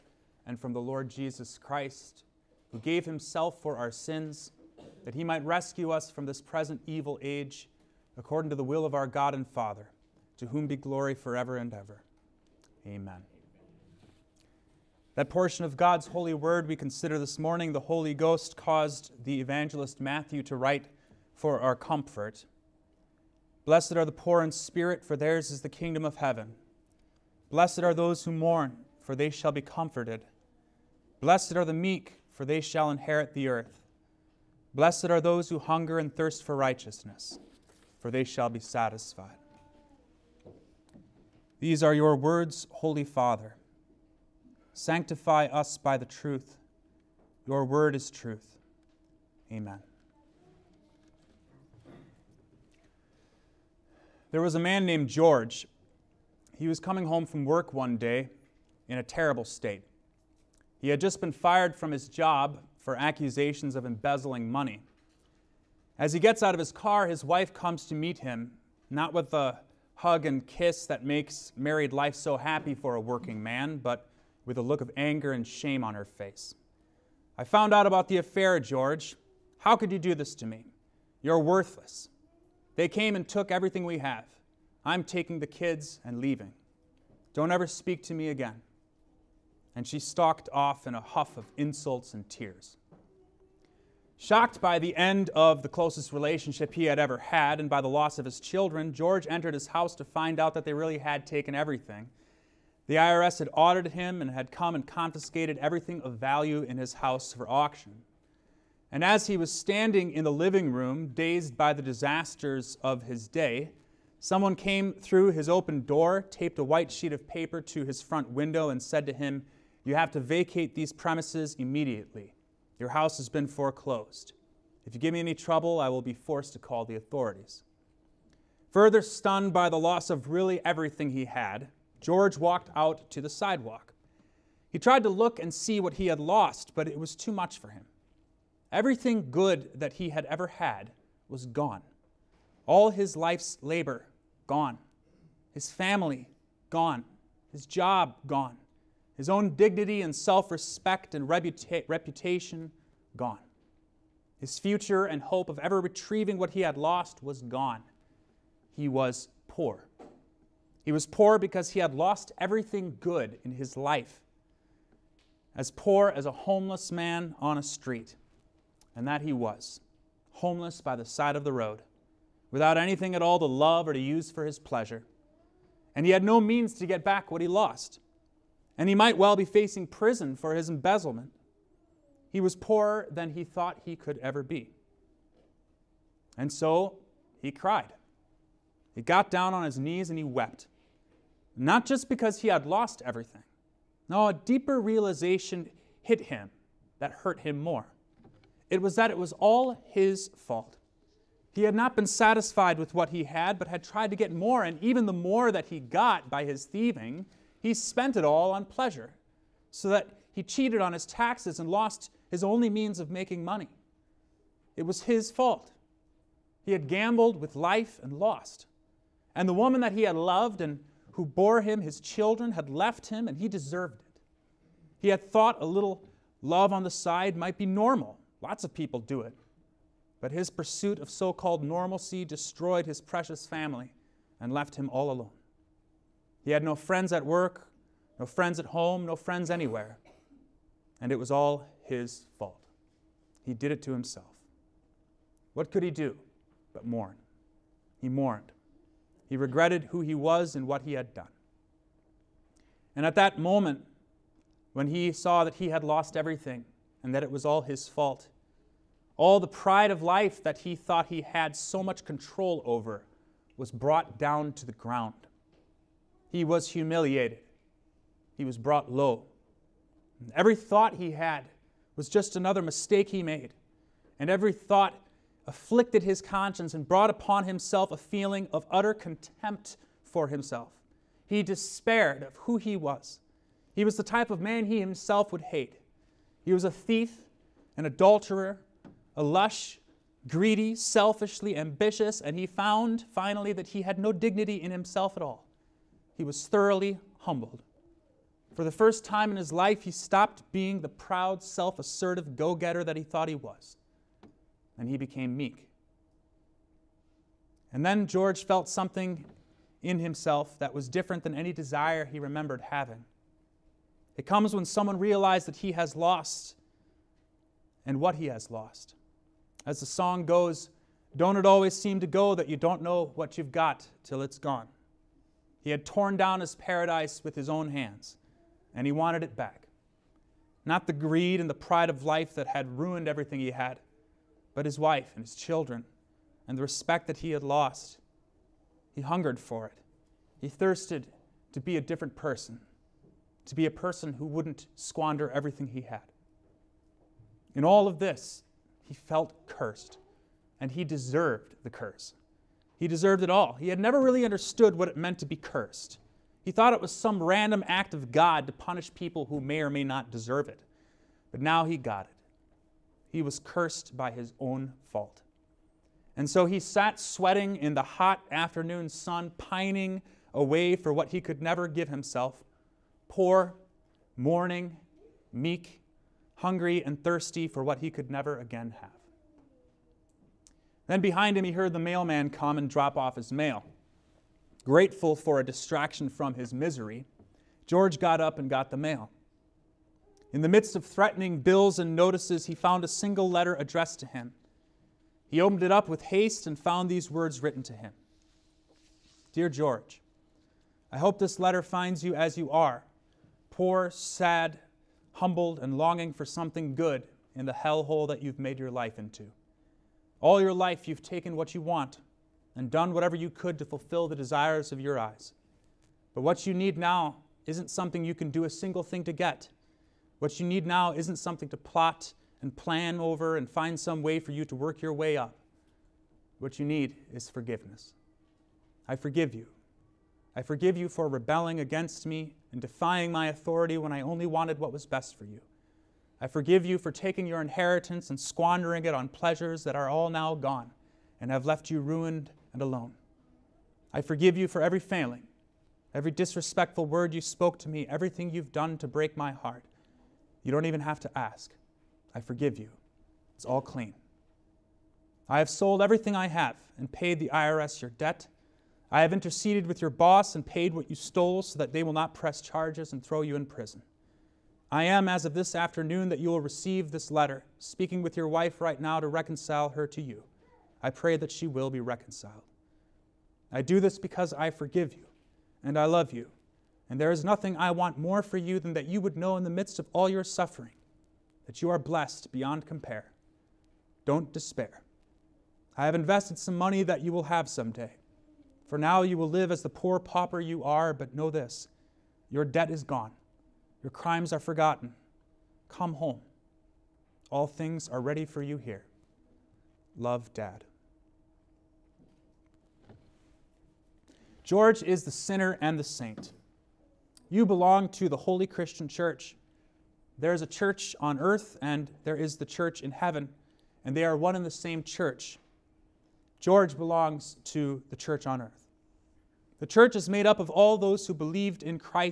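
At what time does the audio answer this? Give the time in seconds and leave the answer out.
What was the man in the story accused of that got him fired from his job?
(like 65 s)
63 s.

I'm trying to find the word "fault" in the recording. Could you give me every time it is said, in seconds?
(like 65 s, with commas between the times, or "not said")
200 s, 215 s, 242 s, 257 s, 364 s.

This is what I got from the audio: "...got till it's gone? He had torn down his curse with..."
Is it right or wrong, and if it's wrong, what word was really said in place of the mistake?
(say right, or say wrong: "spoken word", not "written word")
wrong: "paradise", not "curse".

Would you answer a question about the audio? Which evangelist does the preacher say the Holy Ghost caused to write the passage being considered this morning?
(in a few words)
Matthew.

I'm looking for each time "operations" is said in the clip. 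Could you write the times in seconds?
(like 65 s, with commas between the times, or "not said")
not said.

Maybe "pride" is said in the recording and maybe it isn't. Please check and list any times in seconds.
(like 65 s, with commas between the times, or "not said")
259 s, 331 s.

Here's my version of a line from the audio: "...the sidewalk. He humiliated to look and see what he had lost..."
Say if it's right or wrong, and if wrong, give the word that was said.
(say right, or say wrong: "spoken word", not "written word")
wrong: "tried", not "humiliated".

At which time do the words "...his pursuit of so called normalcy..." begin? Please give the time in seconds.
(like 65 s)
230 s.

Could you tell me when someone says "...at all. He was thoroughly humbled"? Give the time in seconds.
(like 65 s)
295 s.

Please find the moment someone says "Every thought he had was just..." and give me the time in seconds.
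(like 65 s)
270 s.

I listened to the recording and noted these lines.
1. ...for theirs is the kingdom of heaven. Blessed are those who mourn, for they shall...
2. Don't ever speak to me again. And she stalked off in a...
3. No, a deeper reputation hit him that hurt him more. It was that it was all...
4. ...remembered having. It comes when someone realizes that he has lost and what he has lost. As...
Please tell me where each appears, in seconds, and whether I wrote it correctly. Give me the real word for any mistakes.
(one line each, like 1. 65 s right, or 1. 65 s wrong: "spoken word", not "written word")
1. 25 s right
2. 87 s right
3. 194 s wrong: "realization", not "reputation"
4. 312 s right.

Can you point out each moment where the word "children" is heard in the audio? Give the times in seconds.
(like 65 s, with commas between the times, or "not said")
98 s, 221 s, 335 s.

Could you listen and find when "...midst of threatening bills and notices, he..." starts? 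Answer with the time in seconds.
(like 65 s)
390 s.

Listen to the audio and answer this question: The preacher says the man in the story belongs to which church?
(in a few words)
The Holy Christian Church.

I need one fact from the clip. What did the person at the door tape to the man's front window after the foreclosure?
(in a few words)
A white sheet of paper.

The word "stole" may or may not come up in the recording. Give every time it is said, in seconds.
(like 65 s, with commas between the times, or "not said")
460 s.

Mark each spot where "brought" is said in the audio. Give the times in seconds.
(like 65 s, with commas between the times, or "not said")
263 s, 268 s, 276 s.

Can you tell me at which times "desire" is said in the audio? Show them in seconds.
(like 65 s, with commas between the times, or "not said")
311 s, 414 s.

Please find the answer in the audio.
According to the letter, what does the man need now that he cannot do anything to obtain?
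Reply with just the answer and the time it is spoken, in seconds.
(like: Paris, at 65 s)
Forgiveness, at 427 s.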